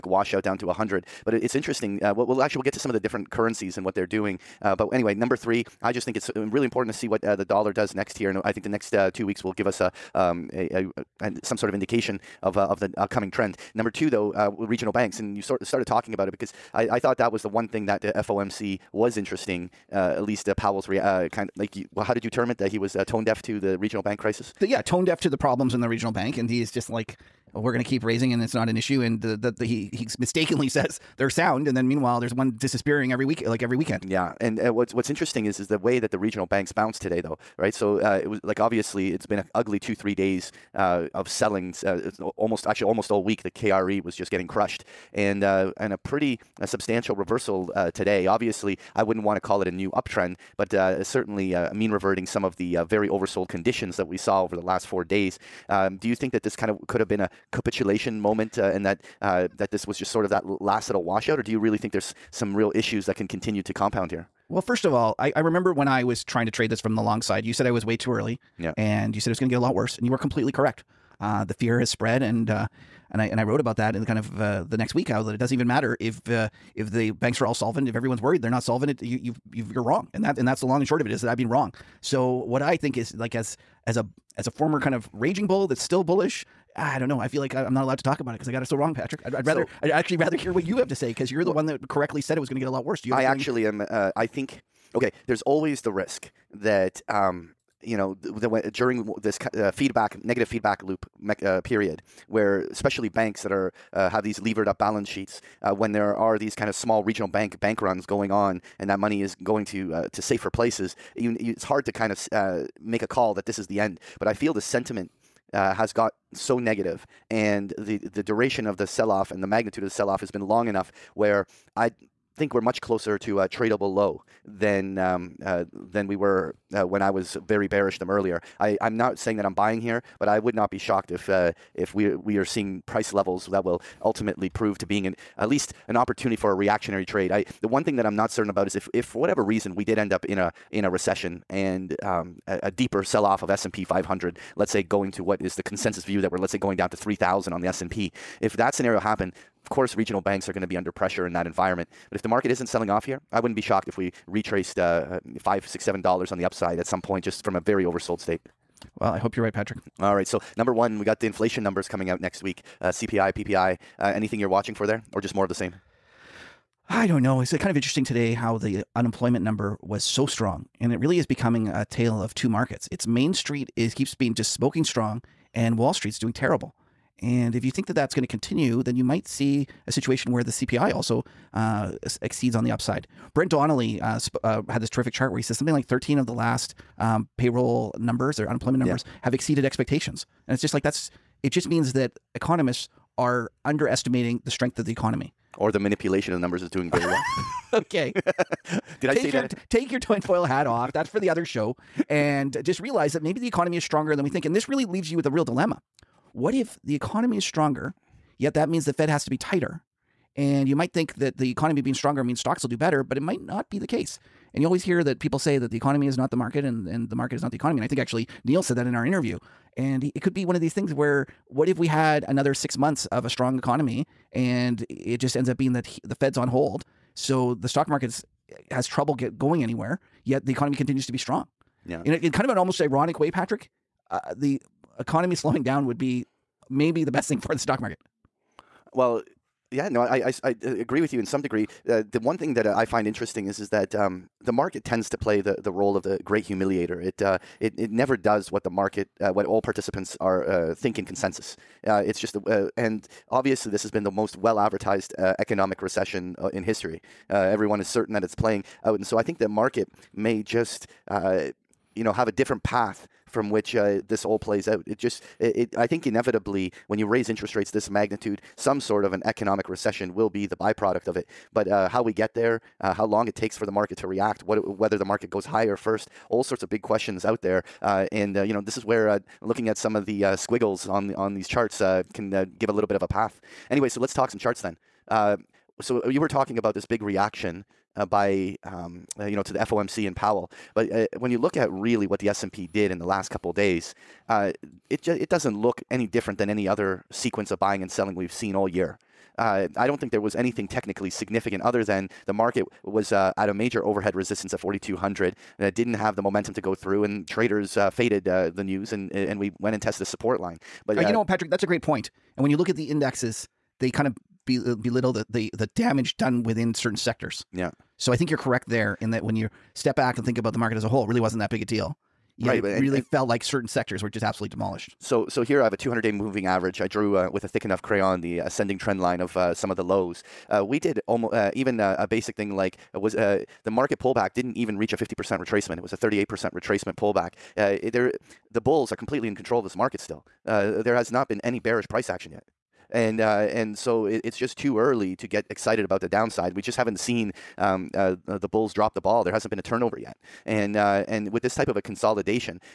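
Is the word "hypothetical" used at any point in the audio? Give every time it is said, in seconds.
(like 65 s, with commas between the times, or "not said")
not said.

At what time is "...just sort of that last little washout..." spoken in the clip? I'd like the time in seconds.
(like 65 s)
59 s.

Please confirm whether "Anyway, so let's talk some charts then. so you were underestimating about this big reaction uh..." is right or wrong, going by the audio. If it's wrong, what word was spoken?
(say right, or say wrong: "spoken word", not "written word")
wrong: "talking", not "underestimating".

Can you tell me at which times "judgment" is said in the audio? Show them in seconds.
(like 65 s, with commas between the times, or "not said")
not said.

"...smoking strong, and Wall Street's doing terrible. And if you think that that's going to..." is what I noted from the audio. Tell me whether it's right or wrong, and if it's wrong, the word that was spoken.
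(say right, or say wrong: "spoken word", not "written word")
right.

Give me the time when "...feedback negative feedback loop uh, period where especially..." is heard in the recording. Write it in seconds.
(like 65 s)
99 s.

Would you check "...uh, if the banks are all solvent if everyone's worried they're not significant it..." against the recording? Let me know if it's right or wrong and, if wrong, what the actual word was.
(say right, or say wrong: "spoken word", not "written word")
wrong: "solvent", not "significant".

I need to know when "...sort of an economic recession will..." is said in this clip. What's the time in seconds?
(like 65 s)
268 s.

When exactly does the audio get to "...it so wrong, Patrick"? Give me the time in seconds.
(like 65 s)
88 s.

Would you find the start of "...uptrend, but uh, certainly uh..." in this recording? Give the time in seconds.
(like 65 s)
49 s.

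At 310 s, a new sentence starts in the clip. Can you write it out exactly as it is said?
But uh, you uh, know, Patrick, that's a great point.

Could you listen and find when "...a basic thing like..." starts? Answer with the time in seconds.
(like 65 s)
331 s.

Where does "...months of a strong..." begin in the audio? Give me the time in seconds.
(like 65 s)
222 s.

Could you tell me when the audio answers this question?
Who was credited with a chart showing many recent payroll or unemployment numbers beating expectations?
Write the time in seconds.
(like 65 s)
183 s.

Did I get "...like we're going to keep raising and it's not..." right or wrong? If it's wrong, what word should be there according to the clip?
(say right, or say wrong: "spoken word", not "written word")
right.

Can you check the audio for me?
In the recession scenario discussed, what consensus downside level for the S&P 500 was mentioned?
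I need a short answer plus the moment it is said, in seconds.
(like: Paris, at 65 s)
3,000, at 146 s.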